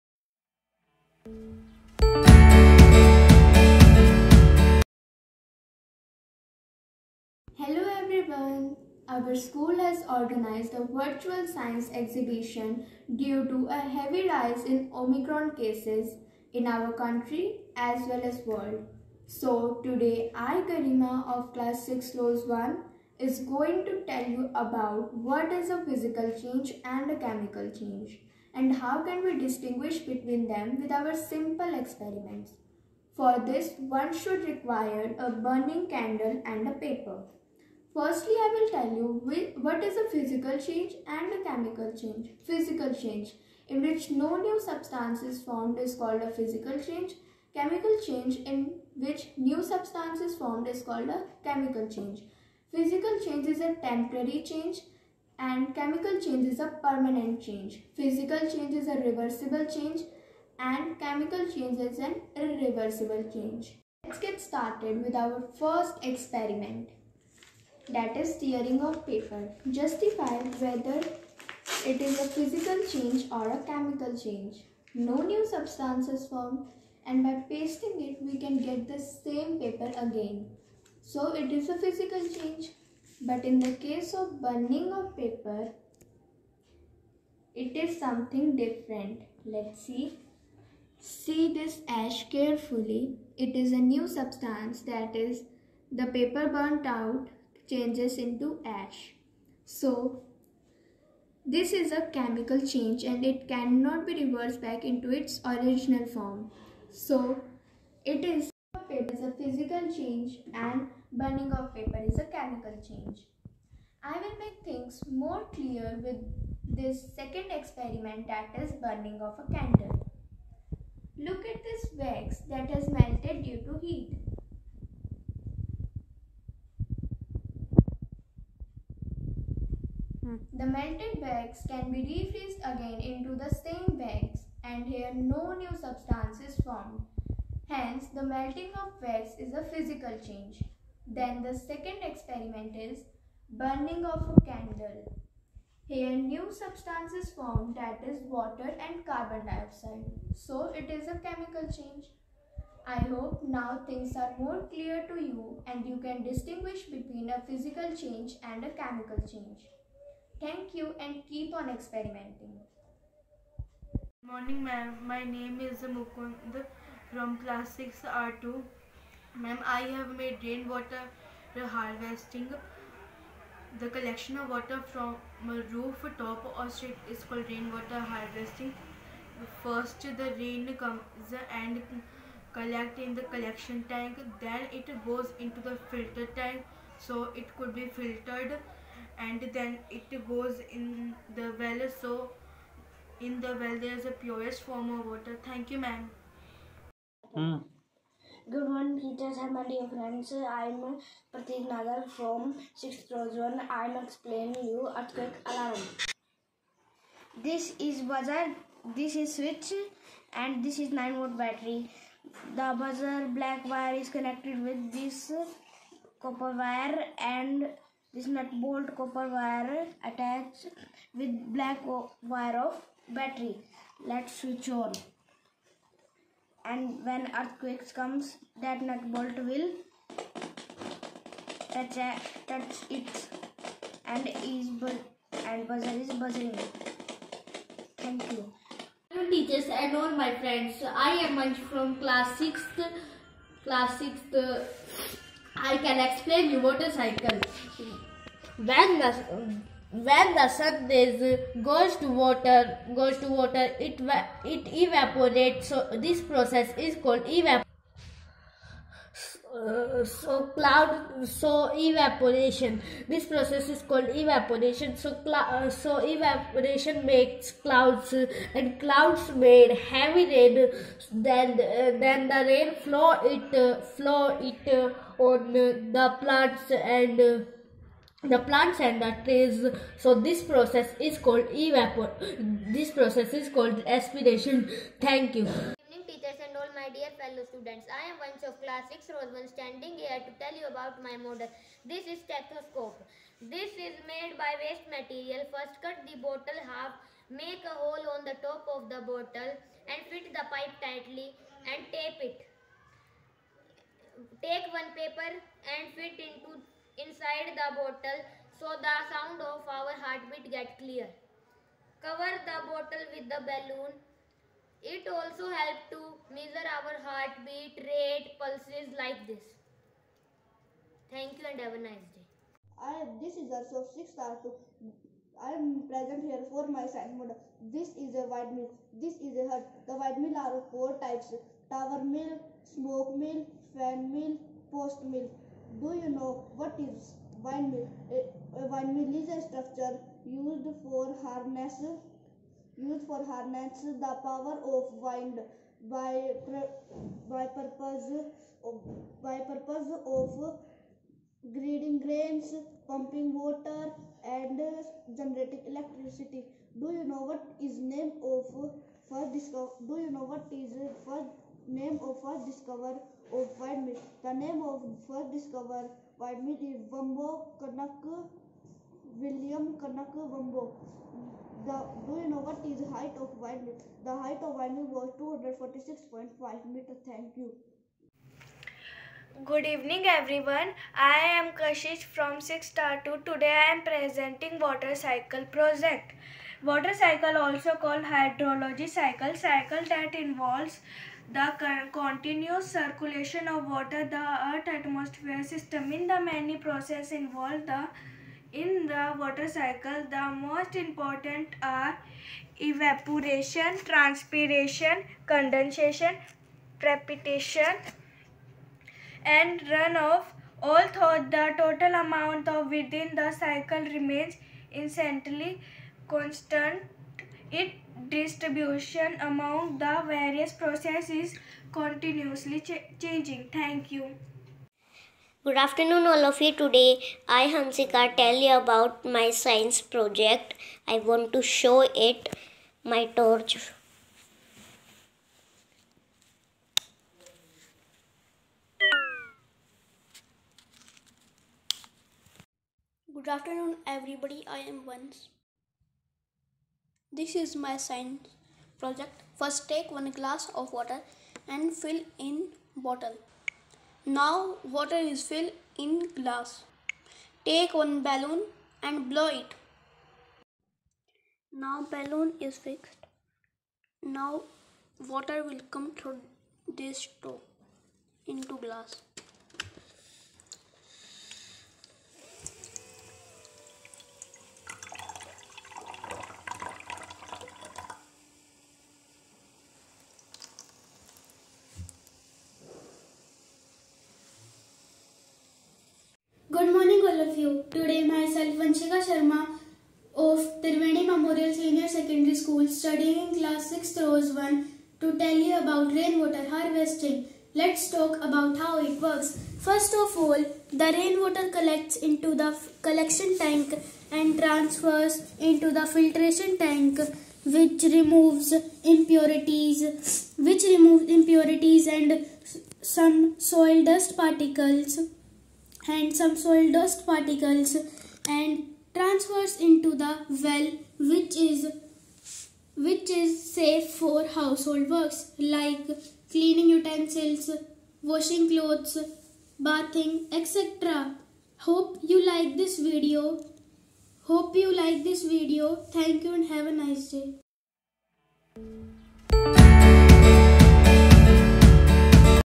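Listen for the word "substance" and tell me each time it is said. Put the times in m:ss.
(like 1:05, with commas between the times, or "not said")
0:44, 0:49, 1:15, 1:34, 2:15, 2:26.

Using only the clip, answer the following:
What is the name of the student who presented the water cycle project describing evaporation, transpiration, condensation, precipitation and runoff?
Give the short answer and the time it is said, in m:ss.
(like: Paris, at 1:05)
Kashish, at 6:21.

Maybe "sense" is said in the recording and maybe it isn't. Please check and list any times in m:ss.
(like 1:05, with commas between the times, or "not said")
not said.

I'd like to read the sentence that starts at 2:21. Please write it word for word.
Then the second experiment is burning of a candle.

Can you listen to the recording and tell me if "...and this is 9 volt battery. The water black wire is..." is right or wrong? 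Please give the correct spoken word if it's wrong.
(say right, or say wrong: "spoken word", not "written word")
wrong: "buzzer", not "water".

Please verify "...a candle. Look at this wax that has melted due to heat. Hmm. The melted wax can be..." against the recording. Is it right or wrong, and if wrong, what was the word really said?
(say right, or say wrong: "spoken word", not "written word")
right.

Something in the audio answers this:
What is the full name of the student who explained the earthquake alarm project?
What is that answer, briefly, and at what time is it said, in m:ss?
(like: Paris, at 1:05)
Pratik Nagar, at 3:21.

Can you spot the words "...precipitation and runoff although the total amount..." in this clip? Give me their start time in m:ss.
6:46.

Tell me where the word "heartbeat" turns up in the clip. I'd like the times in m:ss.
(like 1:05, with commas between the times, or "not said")
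5:09, 5:17.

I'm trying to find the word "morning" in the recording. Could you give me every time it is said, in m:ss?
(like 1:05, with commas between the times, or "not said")
2:44, 3:18.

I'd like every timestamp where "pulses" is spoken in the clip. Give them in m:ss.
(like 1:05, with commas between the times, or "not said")
5:18.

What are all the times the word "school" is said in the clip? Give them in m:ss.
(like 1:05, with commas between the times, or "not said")
0:09, 8:12.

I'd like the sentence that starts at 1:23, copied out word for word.
But in the case of burning of paper, it is something different.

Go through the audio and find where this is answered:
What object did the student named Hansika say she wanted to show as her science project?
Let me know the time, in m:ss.
7:13.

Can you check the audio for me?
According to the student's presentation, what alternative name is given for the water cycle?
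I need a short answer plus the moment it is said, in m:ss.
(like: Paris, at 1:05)
hydrology cycle, at 6:28.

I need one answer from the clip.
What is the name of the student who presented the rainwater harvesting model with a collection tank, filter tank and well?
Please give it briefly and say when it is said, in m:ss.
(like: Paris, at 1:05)
Mukund, at 2:45.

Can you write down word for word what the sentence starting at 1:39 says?
So this is a chemical change and it cannot be reversed back into its original form.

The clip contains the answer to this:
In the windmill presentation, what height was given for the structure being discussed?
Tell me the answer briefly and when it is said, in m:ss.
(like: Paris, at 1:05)
246.5 meters, at 6:15.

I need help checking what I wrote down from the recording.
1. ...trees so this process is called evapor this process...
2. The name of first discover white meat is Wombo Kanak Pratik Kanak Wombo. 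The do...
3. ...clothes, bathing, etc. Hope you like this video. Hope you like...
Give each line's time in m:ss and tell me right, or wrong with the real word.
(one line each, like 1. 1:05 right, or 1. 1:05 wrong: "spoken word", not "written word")
1. 4:39 right
2. 6:04 wrong: "William", not "Pratik"
3. 8:48 right.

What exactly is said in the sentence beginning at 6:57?
Its distribution among the various processes continuously ch changing.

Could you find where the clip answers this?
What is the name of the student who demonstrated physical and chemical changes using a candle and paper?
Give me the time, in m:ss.
0:20.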